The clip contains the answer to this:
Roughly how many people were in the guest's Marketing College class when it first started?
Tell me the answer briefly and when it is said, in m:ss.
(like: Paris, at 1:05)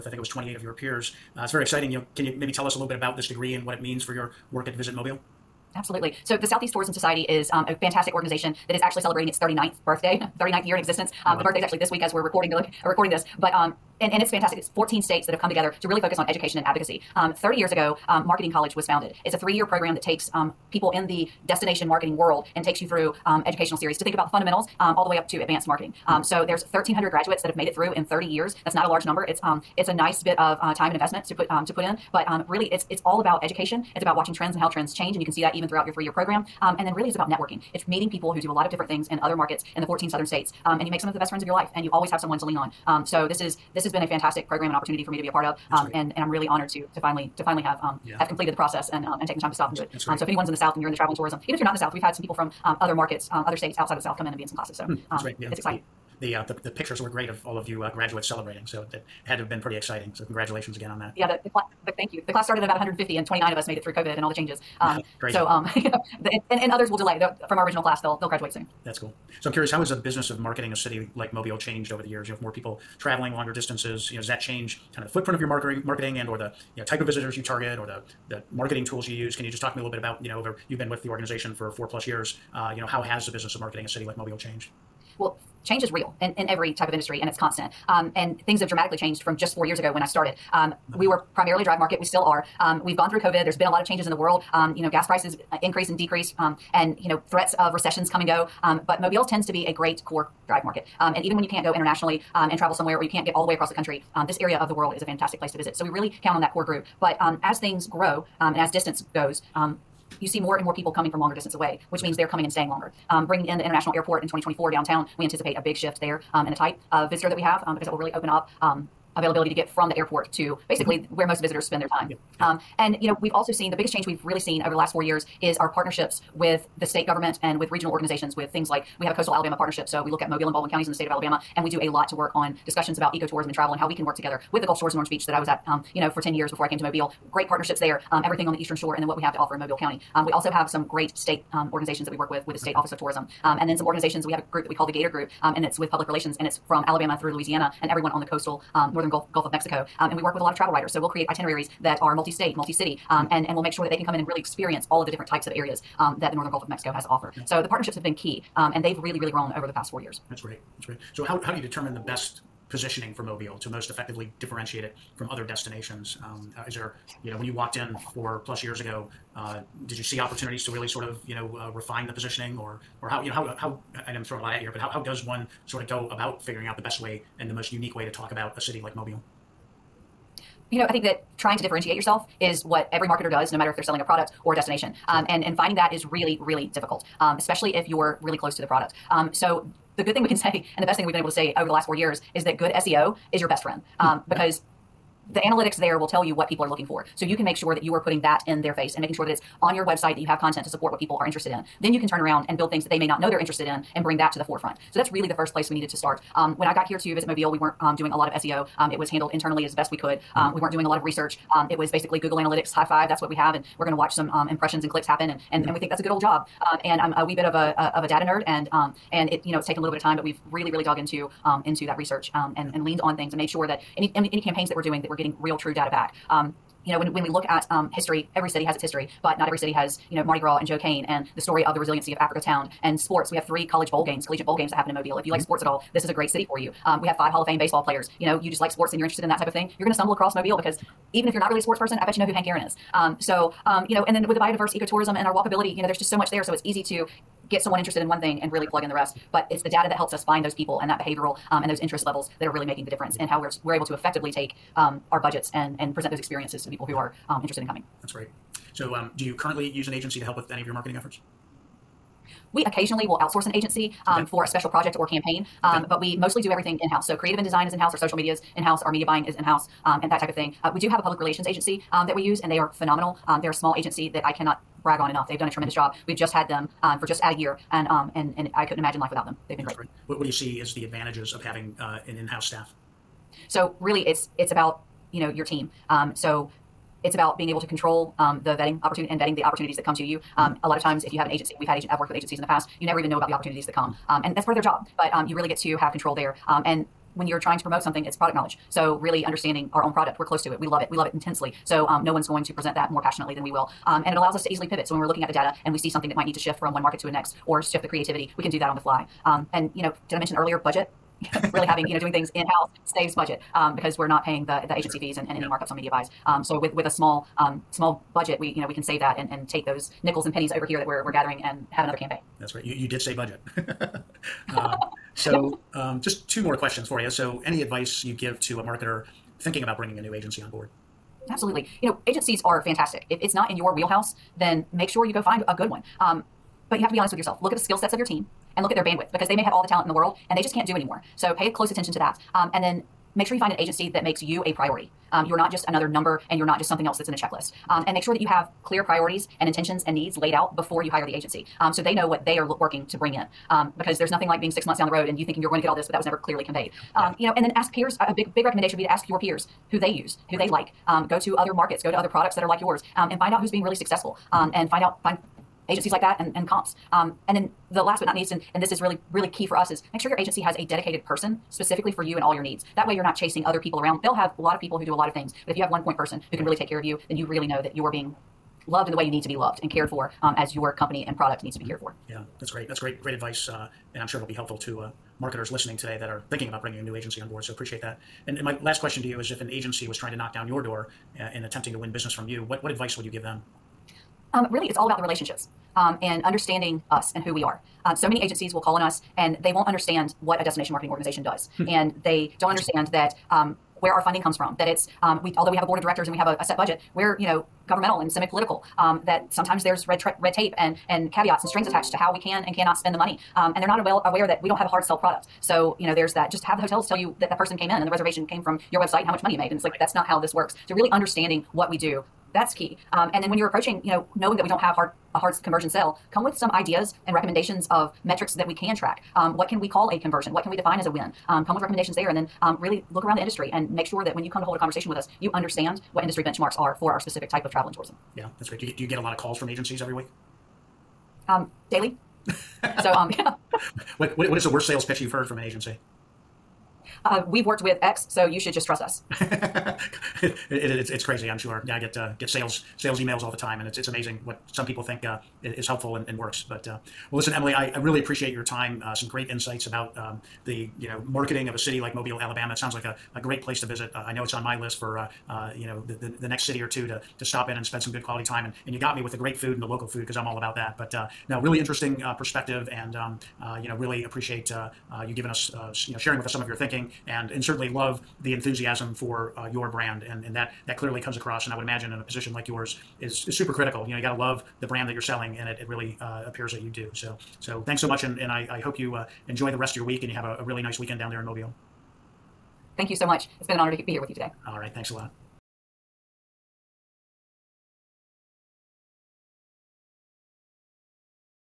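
150, at 1:02.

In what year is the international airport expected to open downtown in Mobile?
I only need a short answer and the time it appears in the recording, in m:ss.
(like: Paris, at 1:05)
2024, at 1:54.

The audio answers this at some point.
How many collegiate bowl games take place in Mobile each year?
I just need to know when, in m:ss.
3:53.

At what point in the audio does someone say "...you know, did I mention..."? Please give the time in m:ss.
5:09.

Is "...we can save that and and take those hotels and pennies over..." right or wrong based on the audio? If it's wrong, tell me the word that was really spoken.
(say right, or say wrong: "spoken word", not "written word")
wrong: "nickels", not "hotels".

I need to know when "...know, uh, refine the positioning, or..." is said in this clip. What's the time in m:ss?
2:51.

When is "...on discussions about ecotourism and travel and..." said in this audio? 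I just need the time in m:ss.
2:12.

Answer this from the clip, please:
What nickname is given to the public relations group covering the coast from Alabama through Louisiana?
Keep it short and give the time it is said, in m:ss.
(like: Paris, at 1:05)
gator group, at 2:24.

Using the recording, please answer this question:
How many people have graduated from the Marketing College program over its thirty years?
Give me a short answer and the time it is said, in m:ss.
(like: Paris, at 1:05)
1,300, at 0:26.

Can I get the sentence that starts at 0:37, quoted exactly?
It's meeting people who do a lot of different things in other markets in the 14 southern states.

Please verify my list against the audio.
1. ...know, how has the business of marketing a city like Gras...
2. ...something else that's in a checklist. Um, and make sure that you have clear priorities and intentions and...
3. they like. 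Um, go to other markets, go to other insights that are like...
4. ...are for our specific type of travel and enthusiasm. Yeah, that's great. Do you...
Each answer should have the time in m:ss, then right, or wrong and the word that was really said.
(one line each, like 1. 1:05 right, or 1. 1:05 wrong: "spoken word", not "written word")
1. 1:22 wrong: "Mobile", not "Gras"
2. 5:46 right
3. 6:00 wrong: "products", not "insights"
4. 7:16 wrong: "tourism", not "enthusiasm".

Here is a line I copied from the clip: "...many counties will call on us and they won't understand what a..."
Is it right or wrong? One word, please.
wrong.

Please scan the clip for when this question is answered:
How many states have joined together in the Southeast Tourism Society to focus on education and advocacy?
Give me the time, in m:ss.
0:14.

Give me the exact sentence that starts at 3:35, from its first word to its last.
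and we think that's a good old job.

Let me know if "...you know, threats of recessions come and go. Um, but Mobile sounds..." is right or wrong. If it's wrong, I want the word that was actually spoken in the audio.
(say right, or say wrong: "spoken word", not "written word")
wrong: "tends", not "sounds".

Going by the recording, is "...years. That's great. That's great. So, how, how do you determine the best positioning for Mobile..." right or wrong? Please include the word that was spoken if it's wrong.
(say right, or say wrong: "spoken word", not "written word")
right.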